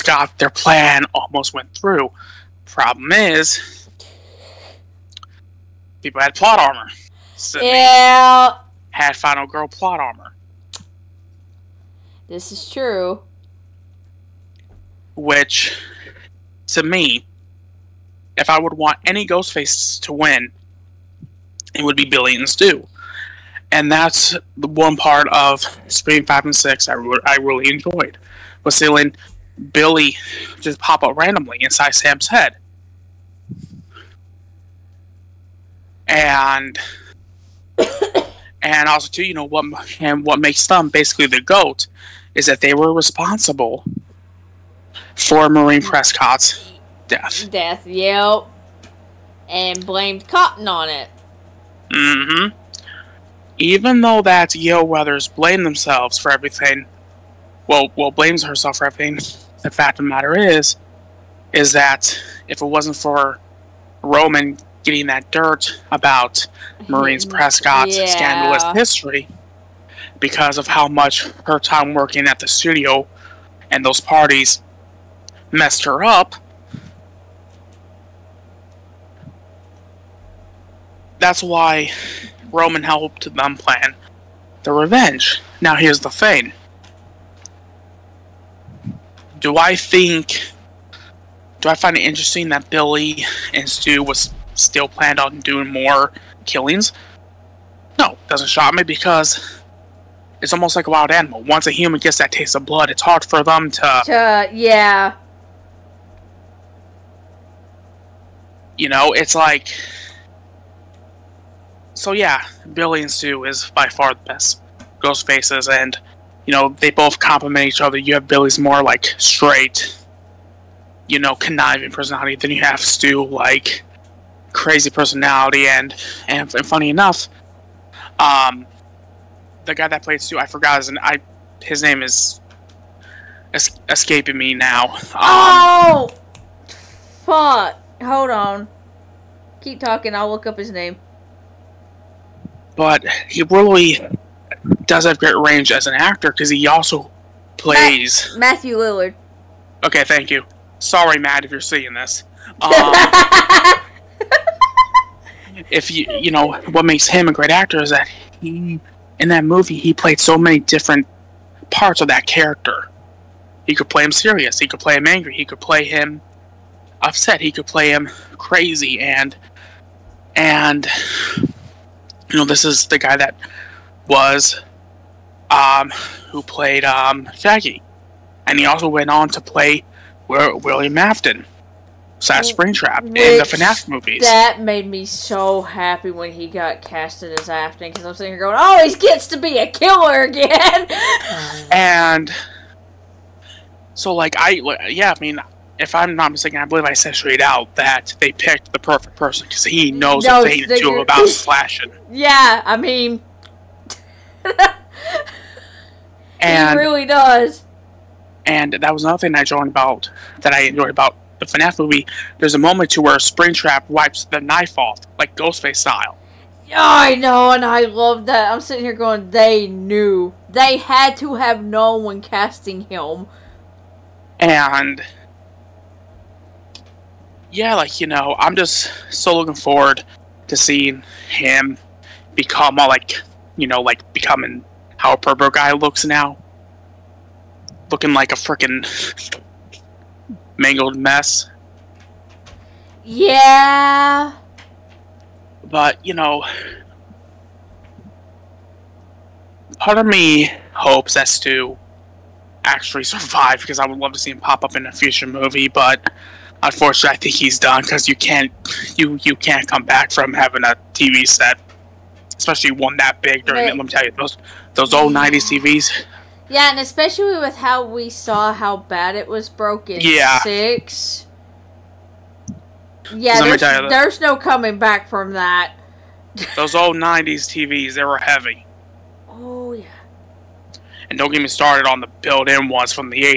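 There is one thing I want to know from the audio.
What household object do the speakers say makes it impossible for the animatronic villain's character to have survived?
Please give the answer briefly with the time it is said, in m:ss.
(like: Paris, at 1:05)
a TV set, at 4:20.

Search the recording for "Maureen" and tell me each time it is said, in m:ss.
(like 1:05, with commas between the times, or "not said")
0:45, 1:06.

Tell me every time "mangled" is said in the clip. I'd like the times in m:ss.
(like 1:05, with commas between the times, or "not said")
4:00.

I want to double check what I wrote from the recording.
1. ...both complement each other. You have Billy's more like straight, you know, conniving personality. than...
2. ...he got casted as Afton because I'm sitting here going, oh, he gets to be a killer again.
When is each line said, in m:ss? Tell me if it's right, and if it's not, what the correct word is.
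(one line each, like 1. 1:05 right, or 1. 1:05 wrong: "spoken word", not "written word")
1. 1:56 right
2. 3:06 right.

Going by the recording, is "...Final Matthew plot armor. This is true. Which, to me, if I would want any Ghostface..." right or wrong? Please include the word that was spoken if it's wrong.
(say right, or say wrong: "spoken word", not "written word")
wrong: "Girl", not "Matthew".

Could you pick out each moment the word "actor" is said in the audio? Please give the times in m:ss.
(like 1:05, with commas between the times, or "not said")
2:25, 2:37.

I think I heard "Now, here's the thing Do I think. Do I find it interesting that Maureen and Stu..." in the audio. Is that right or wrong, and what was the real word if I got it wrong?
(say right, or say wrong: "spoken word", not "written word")
wrong: "Billy", not "Maureen".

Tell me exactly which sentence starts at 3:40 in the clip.
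They had to have known when casting him.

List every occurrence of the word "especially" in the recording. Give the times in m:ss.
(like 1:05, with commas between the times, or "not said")
4:22, 4:26.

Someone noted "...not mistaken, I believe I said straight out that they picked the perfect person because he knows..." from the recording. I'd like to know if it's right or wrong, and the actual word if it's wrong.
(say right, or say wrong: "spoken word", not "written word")
right.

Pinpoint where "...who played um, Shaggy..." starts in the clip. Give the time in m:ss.
2:56.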